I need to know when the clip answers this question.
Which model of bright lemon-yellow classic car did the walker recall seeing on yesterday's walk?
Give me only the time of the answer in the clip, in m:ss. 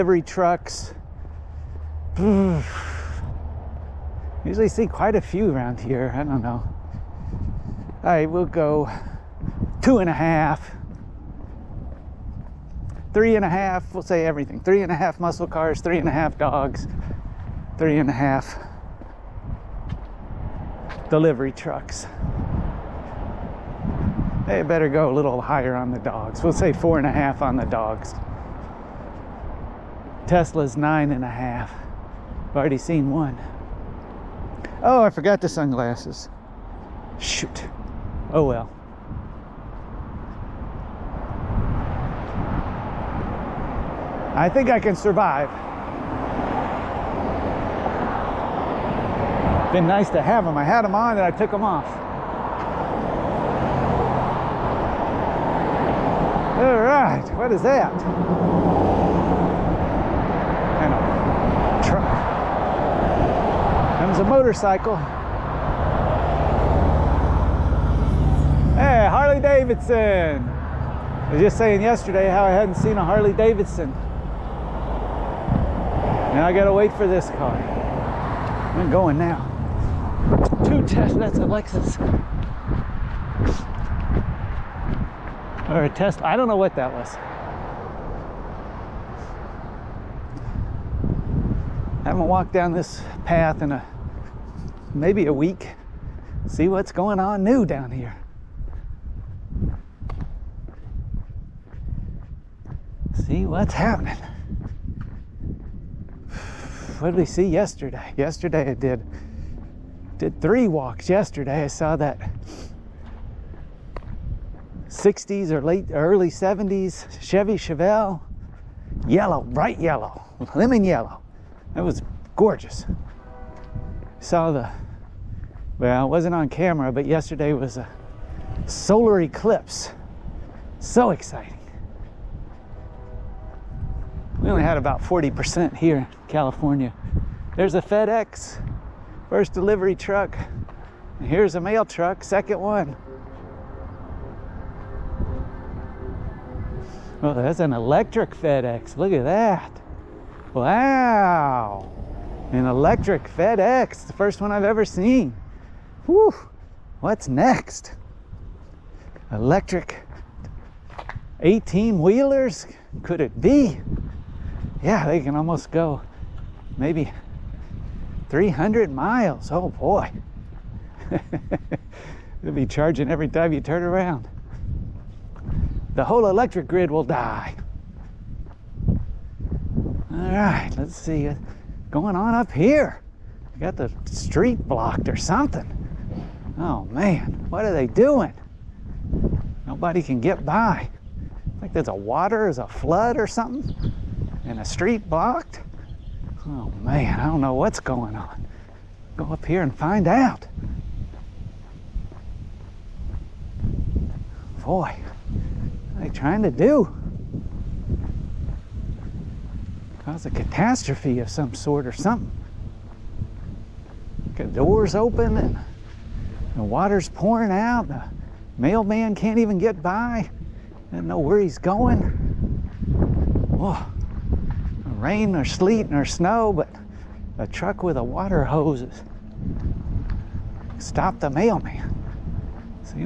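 1:57.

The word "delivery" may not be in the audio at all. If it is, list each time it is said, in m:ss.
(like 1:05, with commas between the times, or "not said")
0:21, 2:19.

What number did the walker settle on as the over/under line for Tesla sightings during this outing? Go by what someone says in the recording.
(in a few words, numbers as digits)
9.5.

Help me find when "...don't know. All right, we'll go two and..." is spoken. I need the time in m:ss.
0:06.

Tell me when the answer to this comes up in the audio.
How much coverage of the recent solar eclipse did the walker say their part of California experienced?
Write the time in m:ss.
2:15.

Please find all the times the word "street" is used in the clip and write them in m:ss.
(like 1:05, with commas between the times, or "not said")
3:04, 3:14.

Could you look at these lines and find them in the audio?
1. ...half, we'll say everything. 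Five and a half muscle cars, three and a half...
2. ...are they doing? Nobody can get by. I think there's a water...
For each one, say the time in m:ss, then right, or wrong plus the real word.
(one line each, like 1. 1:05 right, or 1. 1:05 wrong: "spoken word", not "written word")
1. 0:13 wrong: "Three", not "Five"
2. 3:07 right.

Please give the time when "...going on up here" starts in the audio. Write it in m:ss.
3:01.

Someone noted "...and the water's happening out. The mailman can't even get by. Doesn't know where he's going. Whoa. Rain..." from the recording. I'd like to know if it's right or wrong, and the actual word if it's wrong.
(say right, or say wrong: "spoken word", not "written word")
wrong: "pouring", not "happening".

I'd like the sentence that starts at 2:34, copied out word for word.
The first one I've ever seen.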